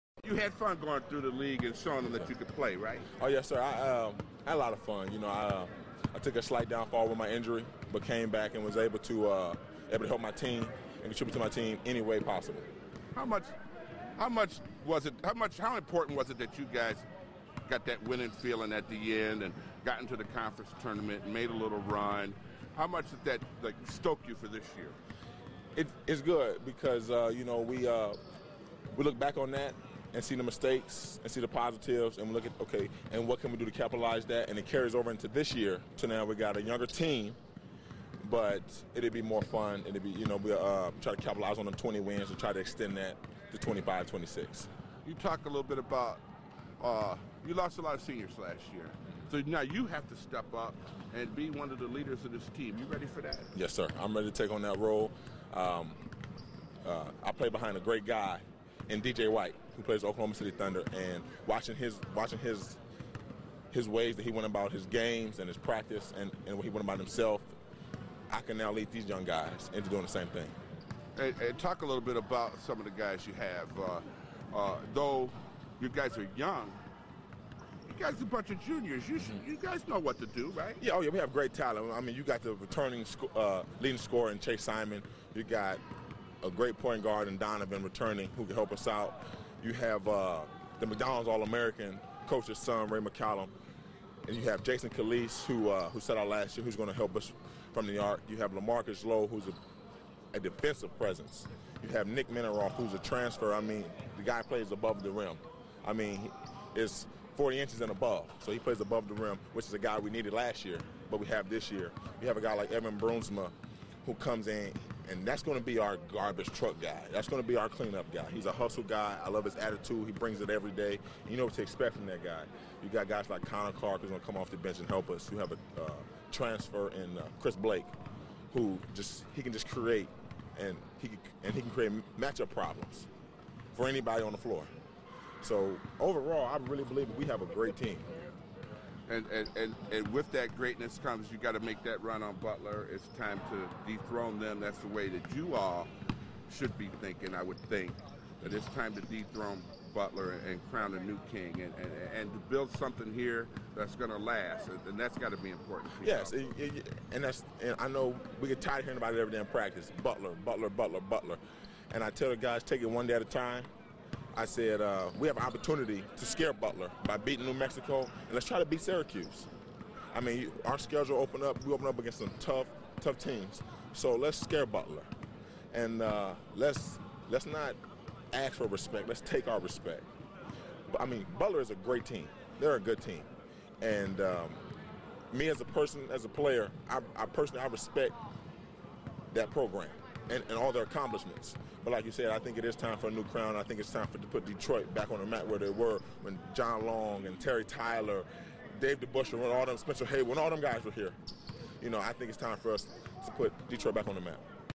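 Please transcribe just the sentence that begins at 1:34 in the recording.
And you have Jason Calliste, who uh, who set out last year, who's going to help us from the arc.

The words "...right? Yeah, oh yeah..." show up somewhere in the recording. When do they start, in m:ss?
1:20.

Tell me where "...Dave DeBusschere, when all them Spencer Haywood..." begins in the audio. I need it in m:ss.
3:18.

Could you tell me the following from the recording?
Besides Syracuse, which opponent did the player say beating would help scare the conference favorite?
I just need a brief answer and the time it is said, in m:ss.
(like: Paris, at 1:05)
New Mexico, at 2:47.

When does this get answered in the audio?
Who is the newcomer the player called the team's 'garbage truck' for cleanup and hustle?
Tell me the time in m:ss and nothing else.
1:52.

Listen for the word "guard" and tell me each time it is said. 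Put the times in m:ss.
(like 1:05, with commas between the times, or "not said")
1:27.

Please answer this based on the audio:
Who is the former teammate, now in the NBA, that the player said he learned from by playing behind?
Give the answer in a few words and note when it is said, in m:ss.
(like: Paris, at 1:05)
DJ White, at 0:59.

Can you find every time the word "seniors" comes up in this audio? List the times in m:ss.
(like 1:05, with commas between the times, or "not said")
0:48.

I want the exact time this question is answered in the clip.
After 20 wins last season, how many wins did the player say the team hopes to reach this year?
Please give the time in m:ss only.
0:43.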